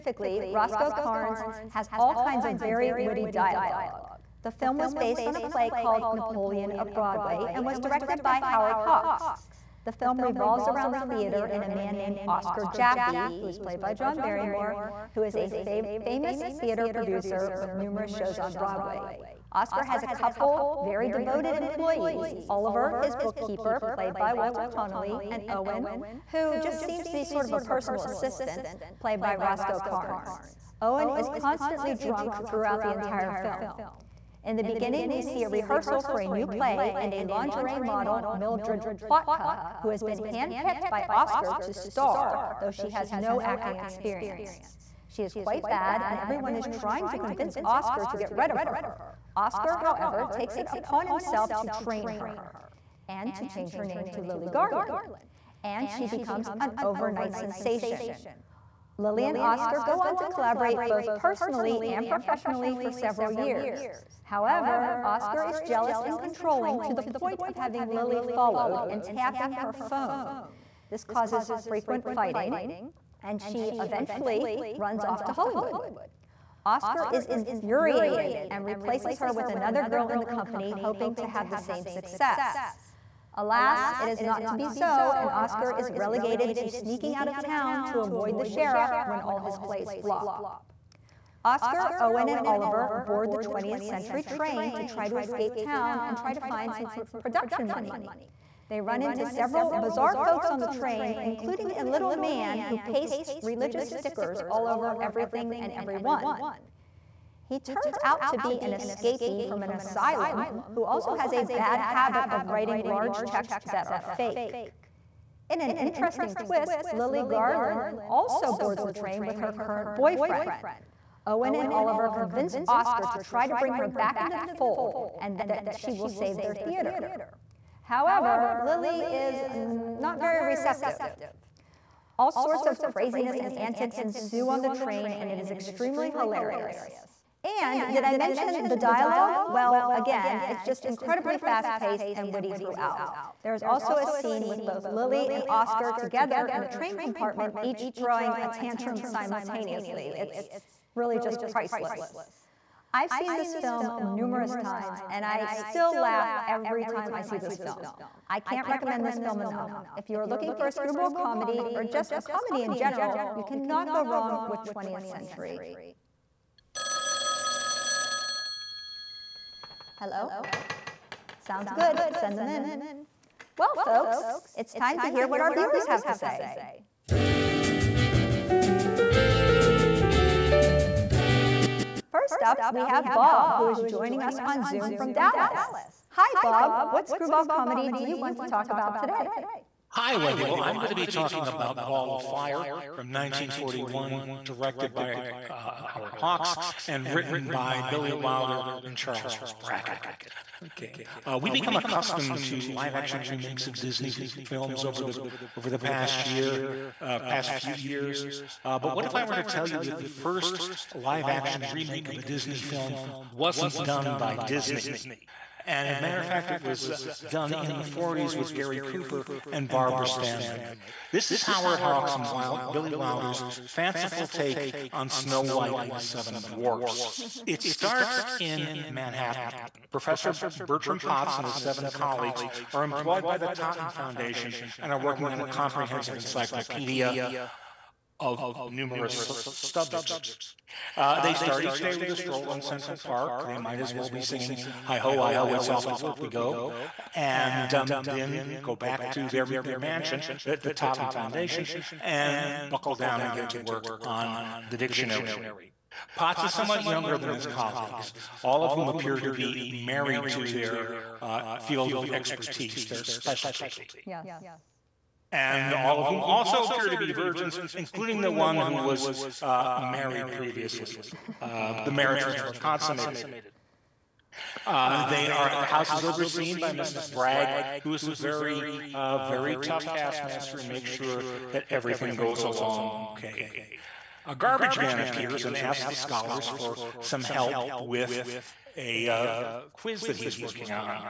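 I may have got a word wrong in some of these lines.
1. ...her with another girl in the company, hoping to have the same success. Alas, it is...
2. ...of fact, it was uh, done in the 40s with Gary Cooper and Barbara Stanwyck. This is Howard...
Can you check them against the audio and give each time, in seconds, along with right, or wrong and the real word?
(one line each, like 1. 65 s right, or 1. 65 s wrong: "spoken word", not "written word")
1. 79 s right
2. 216 s right.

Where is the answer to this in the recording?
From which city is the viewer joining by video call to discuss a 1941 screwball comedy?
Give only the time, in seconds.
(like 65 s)
185 s.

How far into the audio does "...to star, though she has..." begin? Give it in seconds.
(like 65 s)
41 s.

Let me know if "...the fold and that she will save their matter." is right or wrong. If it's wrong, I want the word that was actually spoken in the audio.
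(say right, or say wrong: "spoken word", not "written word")
wrong: "theater", not "matter".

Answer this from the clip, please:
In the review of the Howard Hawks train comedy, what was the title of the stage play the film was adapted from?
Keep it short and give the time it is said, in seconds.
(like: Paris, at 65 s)
Napoleon of Broadway, at 6 s.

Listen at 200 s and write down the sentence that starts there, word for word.
Okay, uh, we become accustomed to live-action remakes of Disney films over the over the past year, uh, past few years.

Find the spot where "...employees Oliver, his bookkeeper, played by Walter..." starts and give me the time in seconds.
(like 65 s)
21 s.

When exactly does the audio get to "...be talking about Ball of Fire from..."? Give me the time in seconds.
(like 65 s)
190 s.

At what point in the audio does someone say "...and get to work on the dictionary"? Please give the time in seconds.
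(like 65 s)
253 s.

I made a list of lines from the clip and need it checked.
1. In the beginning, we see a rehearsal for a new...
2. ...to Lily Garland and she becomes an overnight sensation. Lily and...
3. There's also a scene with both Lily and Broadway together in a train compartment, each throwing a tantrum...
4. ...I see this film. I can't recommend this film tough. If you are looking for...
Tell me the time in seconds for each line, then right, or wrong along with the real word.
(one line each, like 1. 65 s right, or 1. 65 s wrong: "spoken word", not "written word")
1. 34 s right
2. 54 s right
3. 143 s wrong: "Oscar", not "Broadway"
4. 157 s wrong: "enough", not "tough".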